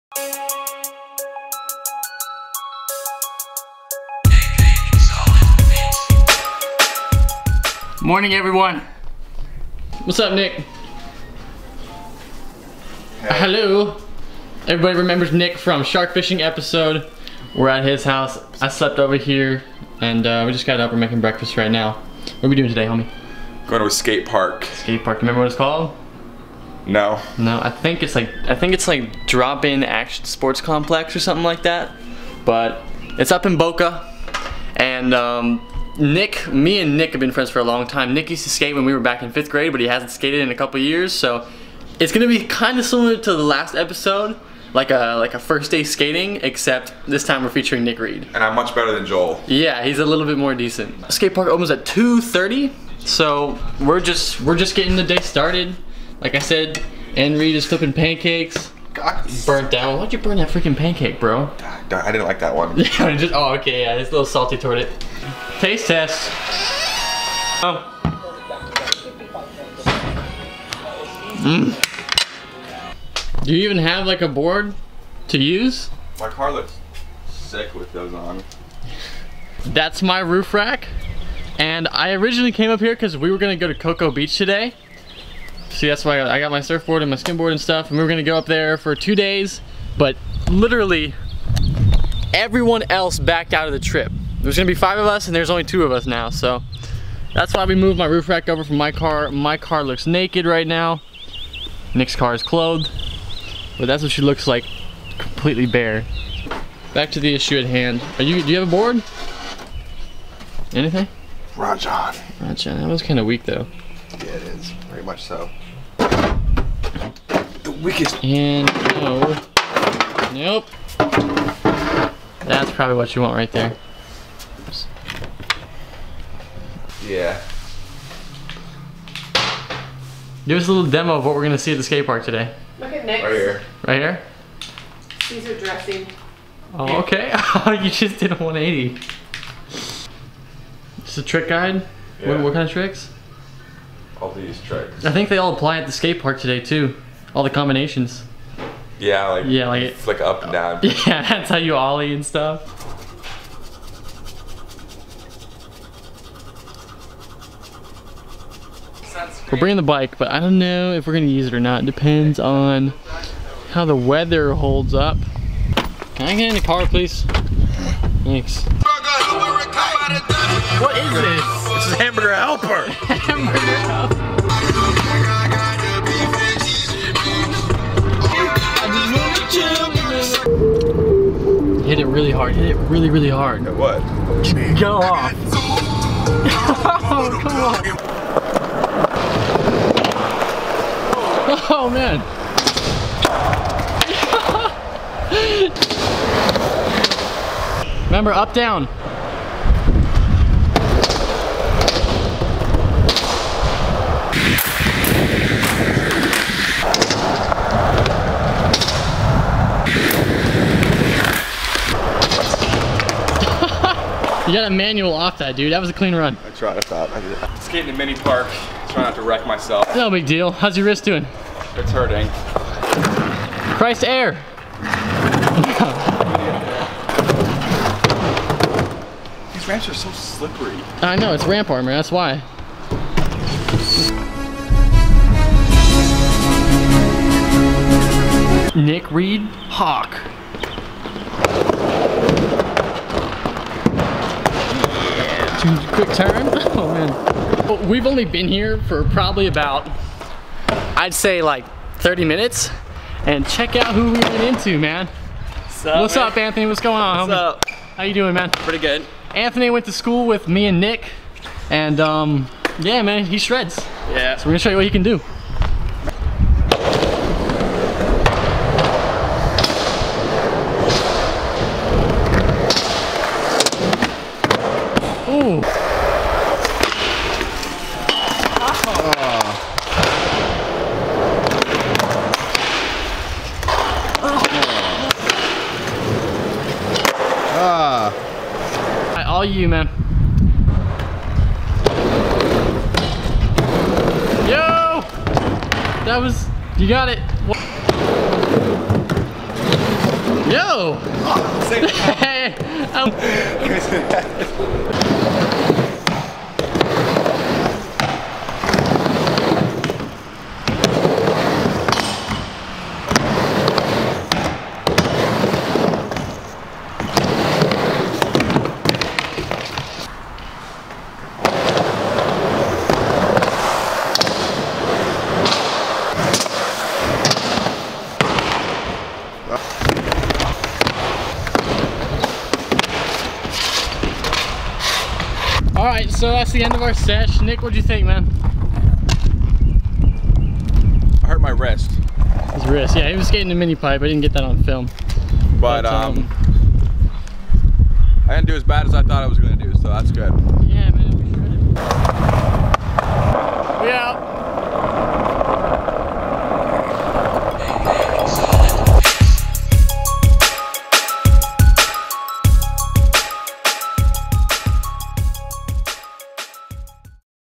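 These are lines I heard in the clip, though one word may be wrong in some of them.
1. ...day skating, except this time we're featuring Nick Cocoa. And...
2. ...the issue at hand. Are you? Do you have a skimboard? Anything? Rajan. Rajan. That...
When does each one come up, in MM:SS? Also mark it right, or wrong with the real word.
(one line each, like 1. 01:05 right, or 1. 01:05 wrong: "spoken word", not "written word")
1. 00:45 wrong: "Read", not "Cocoa"
2. 01:47 wrong: "board", not "skimboard".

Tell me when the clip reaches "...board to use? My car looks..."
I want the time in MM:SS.
01:14.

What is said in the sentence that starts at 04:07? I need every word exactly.
Well, we've only been here for probably about I'd say like 30 minutes and check out who we ran into, man.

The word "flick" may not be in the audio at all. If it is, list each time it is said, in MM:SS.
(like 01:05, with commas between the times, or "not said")
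02:29.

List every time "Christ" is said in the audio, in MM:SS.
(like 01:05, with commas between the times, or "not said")
03:43.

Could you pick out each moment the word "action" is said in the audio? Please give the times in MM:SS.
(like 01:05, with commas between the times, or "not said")
00:29.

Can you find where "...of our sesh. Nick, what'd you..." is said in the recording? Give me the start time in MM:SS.
05:36.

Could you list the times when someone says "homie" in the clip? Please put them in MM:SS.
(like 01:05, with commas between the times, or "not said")
00:22, 04:17.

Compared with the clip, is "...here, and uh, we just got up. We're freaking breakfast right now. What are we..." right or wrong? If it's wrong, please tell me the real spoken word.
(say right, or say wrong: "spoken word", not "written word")
wrong: "making", not "freaking".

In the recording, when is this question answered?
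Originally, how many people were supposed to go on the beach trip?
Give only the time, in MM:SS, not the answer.
01:34.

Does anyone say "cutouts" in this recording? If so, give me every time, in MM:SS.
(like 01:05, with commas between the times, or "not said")
not said.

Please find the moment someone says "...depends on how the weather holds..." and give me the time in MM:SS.
02:41.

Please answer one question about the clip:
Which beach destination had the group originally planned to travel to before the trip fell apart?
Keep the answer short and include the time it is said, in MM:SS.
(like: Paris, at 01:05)
Cocoa Beach, at 01:23.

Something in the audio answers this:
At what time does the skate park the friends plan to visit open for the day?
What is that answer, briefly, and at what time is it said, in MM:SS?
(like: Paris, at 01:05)
2:30, at 00:51.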